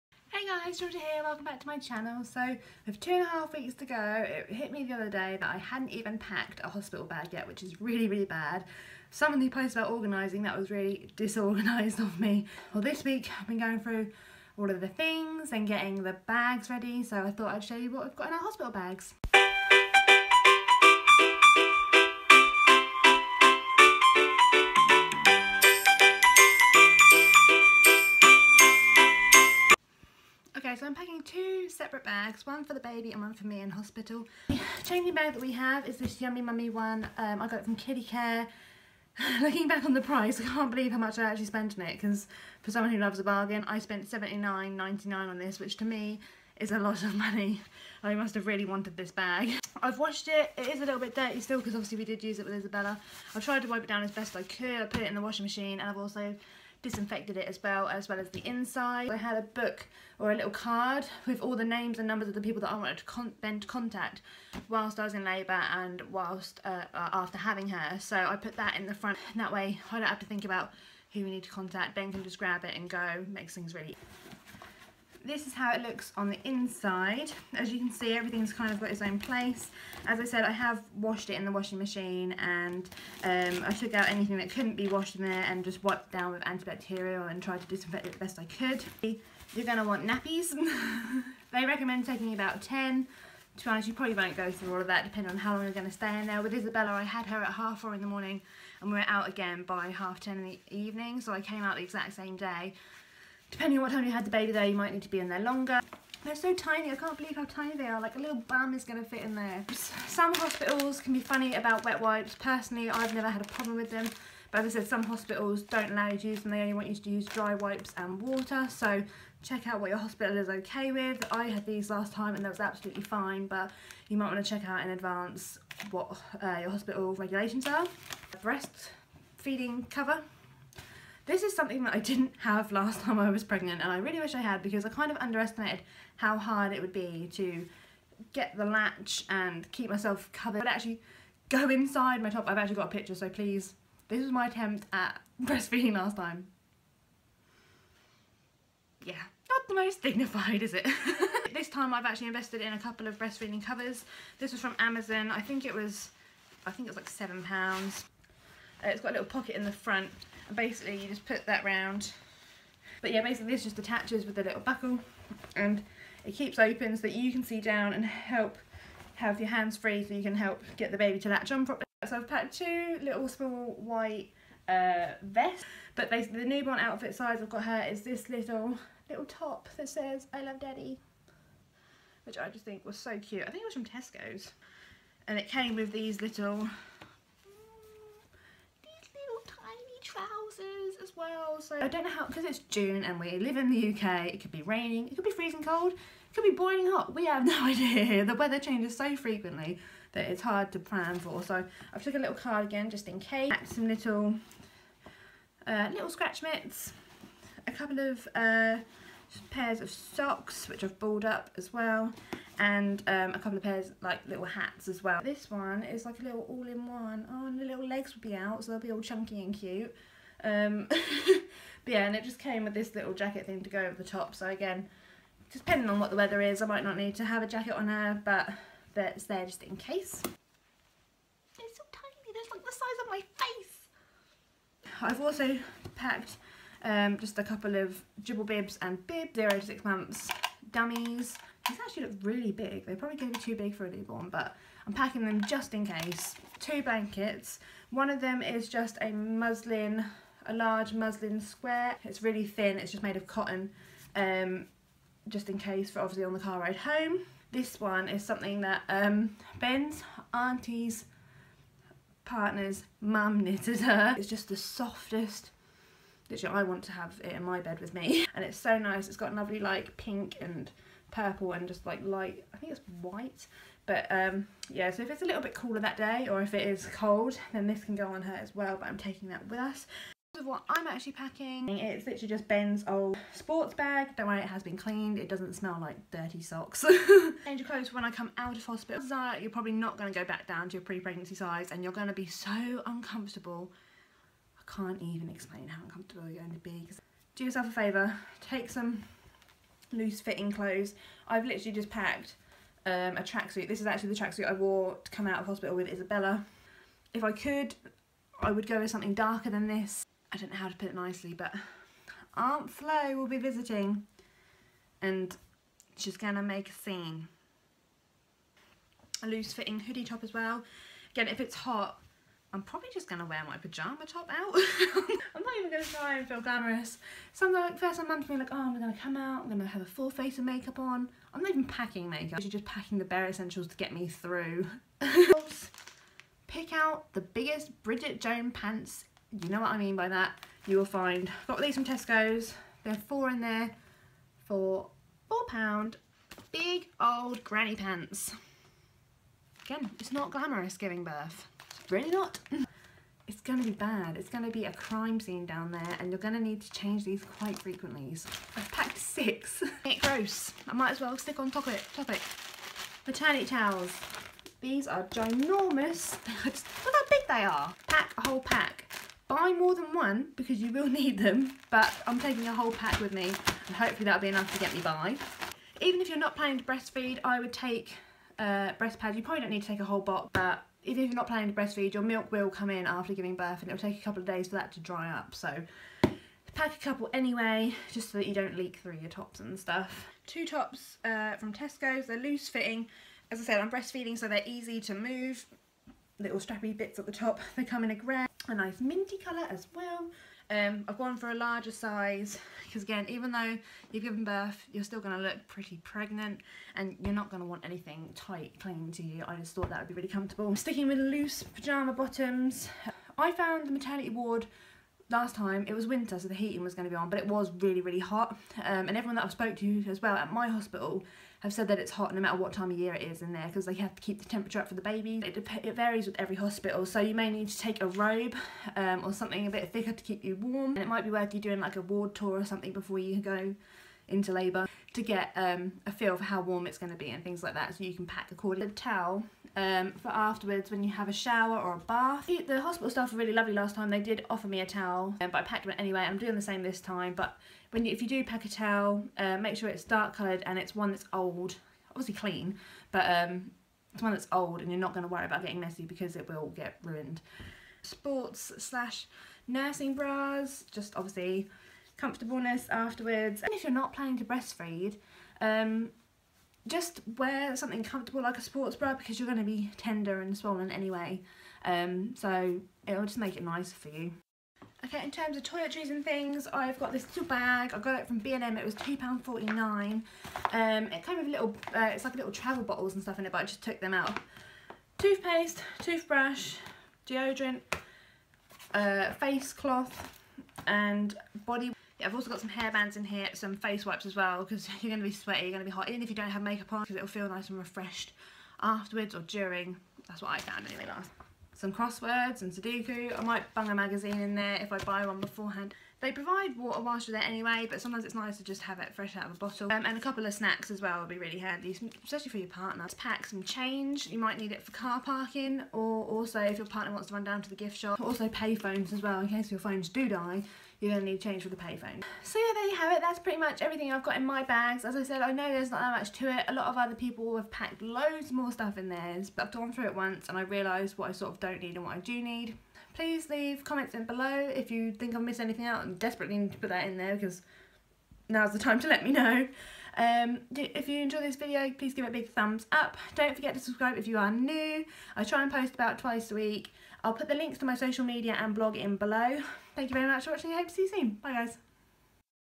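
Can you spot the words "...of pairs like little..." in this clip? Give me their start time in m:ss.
3:33.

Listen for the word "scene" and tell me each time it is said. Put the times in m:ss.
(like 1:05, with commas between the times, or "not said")
5:16, 5:55.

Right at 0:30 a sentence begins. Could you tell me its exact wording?
Okay, so I'm packing two separate bags, one for the baby and one for me in hospital.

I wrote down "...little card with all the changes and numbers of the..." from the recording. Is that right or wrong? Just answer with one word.
wrong.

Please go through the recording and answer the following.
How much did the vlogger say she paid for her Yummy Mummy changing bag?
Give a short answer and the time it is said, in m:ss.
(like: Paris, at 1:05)
£79.99, at 0:44.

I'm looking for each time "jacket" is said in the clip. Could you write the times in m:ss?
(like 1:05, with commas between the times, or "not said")
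3:43, 3:47.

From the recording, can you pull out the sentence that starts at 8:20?
That's what I found anyway last.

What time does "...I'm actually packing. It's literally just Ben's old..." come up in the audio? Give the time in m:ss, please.
4:40.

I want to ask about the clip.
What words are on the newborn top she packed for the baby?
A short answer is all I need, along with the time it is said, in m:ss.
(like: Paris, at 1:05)
I love daddy, at 3:00.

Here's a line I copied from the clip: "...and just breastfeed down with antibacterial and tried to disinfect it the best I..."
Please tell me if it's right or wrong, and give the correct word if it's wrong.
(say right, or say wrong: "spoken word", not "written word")
wrong: "wiped", not "breastfeed".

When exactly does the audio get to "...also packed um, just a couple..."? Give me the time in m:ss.
3:55.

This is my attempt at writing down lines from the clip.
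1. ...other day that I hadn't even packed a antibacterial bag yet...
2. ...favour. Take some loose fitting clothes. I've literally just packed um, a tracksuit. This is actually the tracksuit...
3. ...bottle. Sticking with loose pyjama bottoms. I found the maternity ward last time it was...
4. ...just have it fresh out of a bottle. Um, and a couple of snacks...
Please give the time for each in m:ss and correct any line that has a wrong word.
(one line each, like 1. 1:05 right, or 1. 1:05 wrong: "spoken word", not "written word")
1. 0:04 wrong: "hospital", not "antibacterial"
2. 4:57 right
3. 6:50 wrong: "comfortable", not "bottle"
4. 8:28 right.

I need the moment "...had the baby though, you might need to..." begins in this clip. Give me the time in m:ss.
1:44.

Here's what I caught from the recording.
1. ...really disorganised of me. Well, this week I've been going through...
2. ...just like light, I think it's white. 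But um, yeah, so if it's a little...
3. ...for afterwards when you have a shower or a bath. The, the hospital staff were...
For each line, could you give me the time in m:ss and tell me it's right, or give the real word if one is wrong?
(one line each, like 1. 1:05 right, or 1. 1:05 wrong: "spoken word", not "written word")
1. 0:10 right
2. 4:31 right
3. 7:20 right.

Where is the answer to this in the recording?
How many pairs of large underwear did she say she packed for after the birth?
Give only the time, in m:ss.
5:58.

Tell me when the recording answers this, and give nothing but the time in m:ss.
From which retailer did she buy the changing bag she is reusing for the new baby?
0:37.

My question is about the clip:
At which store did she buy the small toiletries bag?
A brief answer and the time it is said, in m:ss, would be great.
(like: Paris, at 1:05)
B&M, at 7:58.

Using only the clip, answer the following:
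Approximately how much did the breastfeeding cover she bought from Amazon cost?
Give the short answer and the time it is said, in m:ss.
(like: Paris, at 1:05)
£7, at 2:37.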